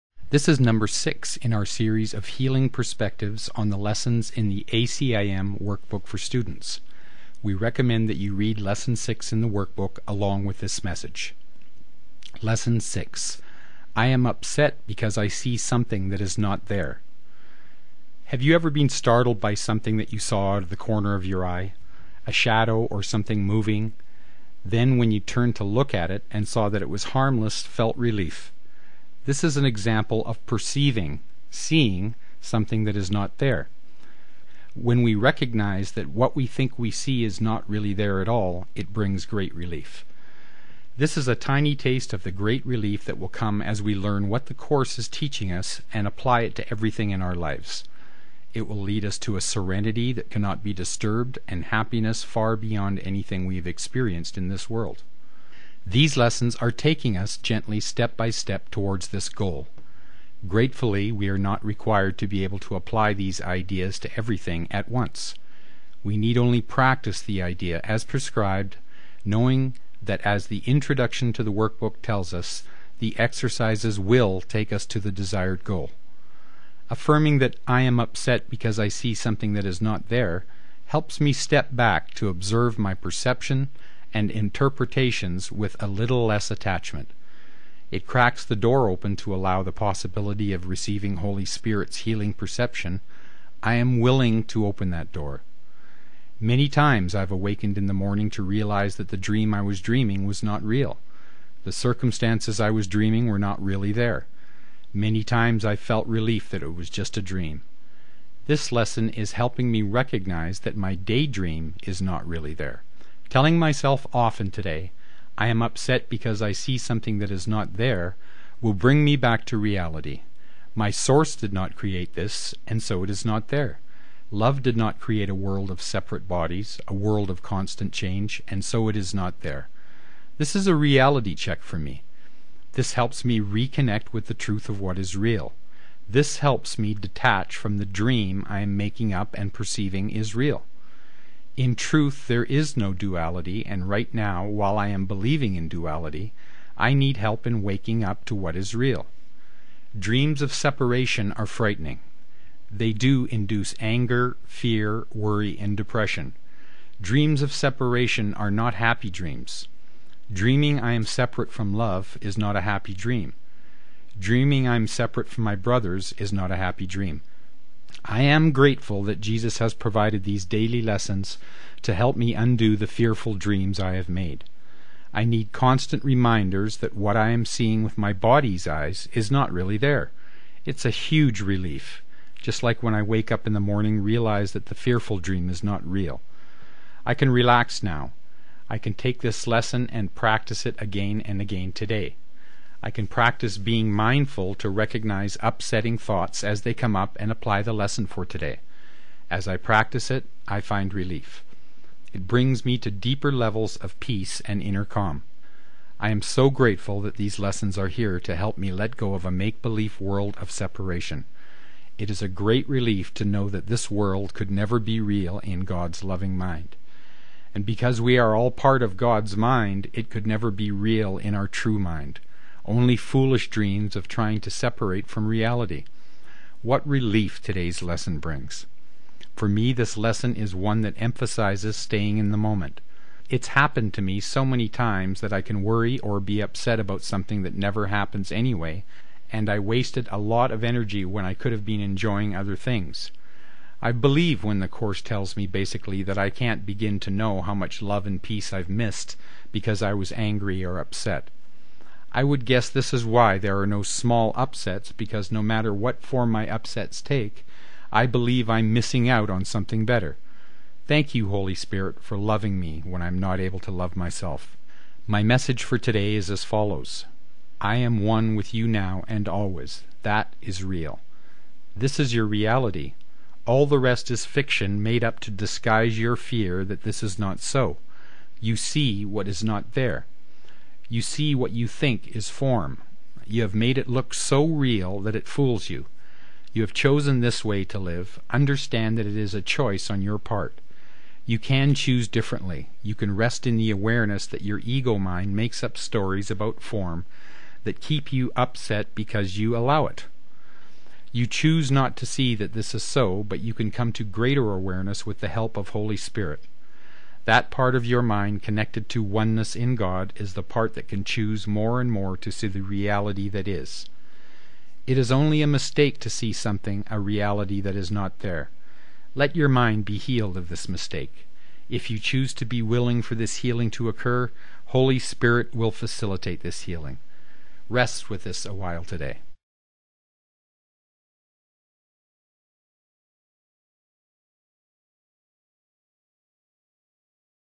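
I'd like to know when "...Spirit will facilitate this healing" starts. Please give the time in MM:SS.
05:24.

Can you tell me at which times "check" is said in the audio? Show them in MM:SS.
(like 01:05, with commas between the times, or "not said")
02:11.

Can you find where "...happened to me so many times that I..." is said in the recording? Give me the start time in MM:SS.
03:53.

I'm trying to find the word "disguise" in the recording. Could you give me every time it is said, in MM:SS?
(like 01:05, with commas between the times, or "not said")
04:35.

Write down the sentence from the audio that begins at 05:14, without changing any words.
It is only a mistake to see something, a reality that is not there.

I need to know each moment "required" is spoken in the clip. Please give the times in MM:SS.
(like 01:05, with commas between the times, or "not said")
01:01.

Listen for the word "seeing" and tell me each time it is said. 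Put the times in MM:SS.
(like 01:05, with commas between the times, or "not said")
00:31, 02:57.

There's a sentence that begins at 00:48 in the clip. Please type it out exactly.
It will lead us to a serenity that cannot be disturbed and happiness far beyond anything we have experienced in this world.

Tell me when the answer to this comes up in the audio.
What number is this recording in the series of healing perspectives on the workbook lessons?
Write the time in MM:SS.
00:00.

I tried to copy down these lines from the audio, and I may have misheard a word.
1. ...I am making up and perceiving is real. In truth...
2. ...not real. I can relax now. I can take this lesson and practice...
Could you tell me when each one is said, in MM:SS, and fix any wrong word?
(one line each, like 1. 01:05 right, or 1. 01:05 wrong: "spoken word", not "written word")
1. 02:18 right
2. 03:05 right.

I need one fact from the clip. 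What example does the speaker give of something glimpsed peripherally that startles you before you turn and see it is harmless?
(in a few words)
A shadow.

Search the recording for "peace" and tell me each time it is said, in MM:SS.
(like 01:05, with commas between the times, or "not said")
03:23, 04:08.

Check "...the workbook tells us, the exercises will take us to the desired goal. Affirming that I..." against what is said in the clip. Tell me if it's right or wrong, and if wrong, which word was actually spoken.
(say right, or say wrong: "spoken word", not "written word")
right.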